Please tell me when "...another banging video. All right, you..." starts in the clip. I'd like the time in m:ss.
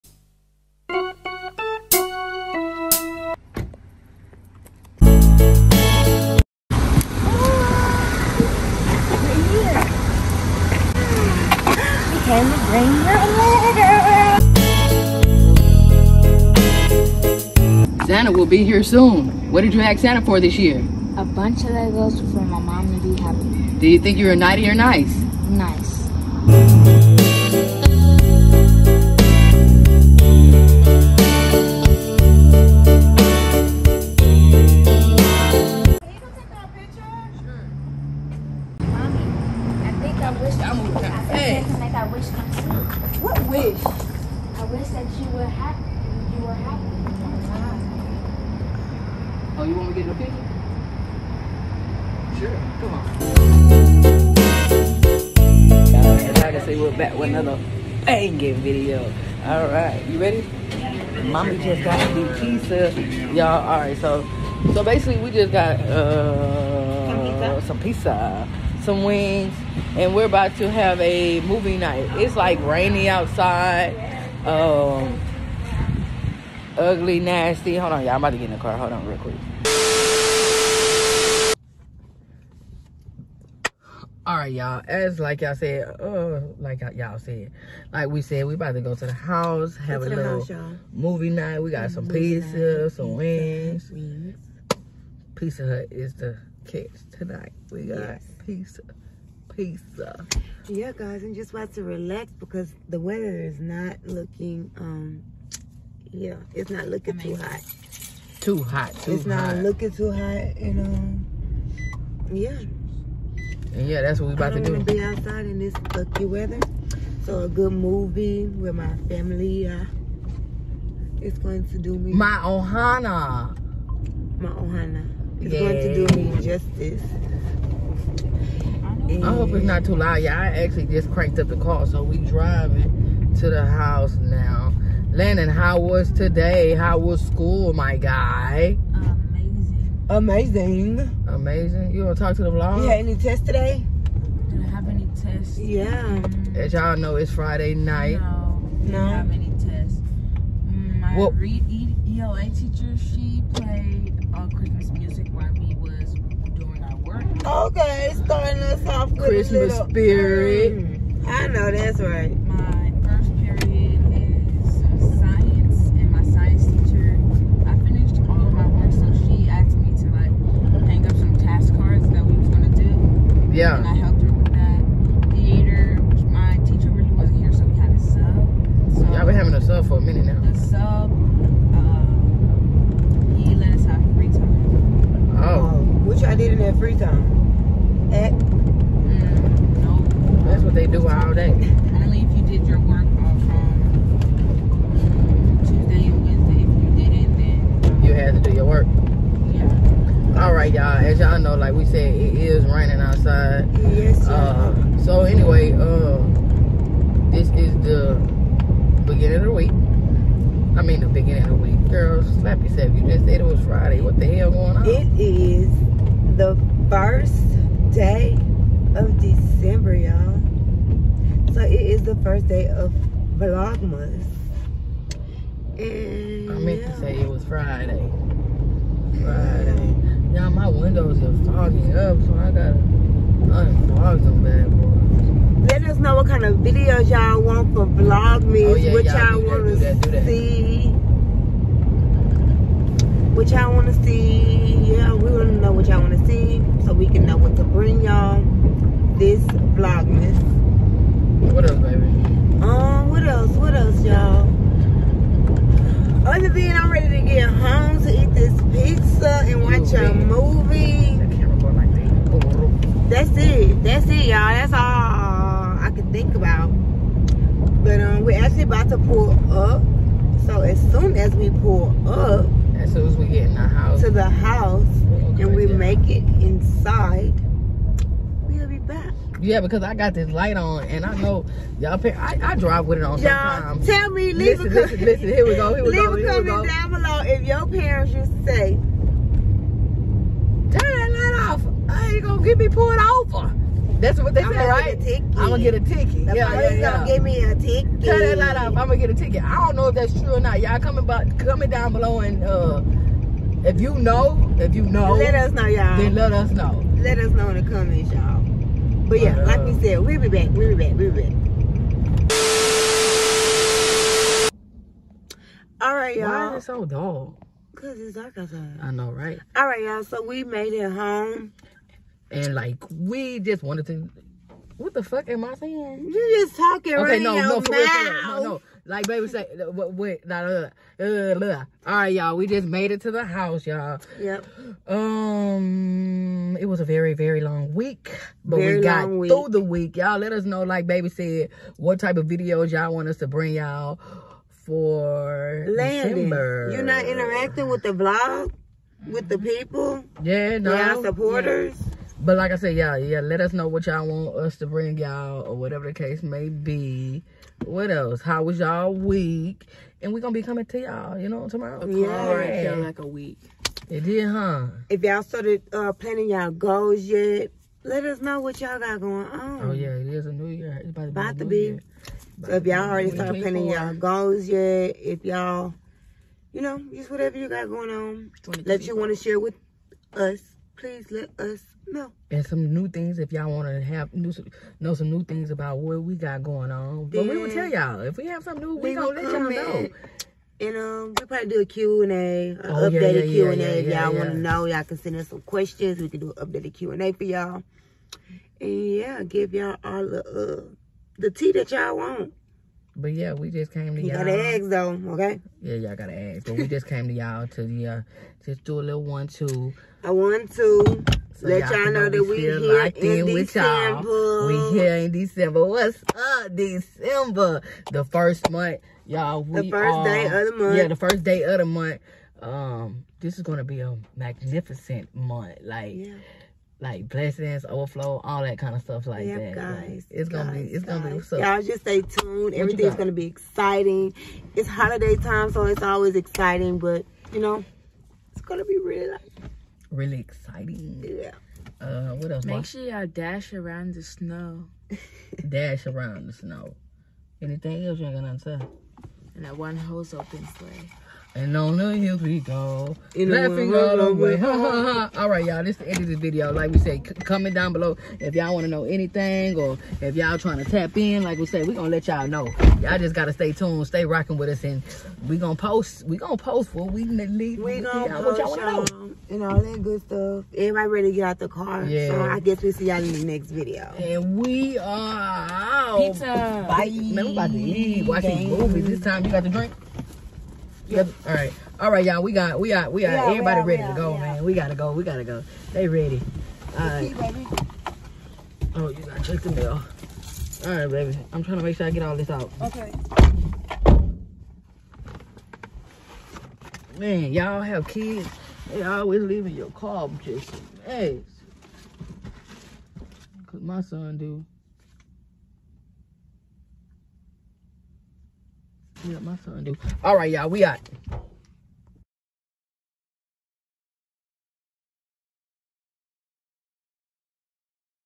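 0:57.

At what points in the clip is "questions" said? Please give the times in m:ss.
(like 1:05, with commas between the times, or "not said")
6:35.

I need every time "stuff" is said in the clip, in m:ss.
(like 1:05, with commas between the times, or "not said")
7:08, 7:50.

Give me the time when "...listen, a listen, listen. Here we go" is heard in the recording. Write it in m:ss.
4:44.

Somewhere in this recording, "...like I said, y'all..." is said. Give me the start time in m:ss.
5:52.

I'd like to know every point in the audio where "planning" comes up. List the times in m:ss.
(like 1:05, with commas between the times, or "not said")
6:05, 6:13.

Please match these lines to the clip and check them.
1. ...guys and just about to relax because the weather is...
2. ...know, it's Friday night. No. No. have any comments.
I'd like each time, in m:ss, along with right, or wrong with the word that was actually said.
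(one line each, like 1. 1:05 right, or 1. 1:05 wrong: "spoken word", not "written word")
1. 1:40 right
2. 2:26 wrong: "tests", not "comments".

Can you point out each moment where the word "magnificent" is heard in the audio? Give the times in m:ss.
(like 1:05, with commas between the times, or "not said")
7:04.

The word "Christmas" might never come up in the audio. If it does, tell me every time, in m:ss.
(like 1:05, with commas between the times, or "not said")
2:34, 2:39.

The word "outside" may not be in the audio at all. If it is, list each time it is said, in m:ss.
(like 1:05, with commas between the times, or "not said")
1:13, 1:55, 3:22, 5:18.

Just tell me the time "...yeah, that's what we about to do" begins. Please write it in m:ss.
1:53.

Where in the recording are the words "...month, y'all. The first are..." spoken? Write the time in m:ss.
6:58.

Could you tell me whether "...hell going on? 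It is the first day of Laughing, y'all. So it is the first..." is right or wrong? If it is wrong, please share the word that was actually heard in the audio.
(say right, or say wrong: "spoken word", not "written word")
wrong: "December", not "Laughing".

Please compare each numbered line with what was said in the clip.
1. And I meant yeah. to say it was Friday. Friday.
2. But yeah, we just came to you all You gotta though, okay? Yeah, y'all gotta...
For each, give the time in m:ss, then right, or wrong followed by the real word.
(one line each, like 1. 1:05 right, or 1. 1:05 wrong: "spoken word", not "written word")
1. 3:45 right
2. 6:42 right.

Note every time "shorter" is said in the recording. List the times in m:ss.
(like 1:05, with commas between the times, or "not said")
not said.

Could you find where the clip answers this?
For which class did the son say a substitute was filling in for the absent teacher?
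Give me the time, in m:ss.
2:55.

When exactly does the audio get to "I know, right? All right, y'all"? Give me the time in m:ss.
5:18.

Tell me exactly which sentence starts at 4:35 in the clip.
make it inside, we'll be back.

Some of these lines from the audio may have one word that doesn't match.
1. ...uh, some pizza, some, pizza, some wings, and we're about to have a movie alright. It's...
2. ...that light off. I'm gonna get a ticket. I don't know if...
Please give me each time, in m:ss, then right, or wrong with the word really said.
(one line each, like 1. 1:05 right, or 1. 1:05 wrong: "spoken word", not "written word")
1. 1:05 wrong: "night", not "alright"
2. 4:58 right.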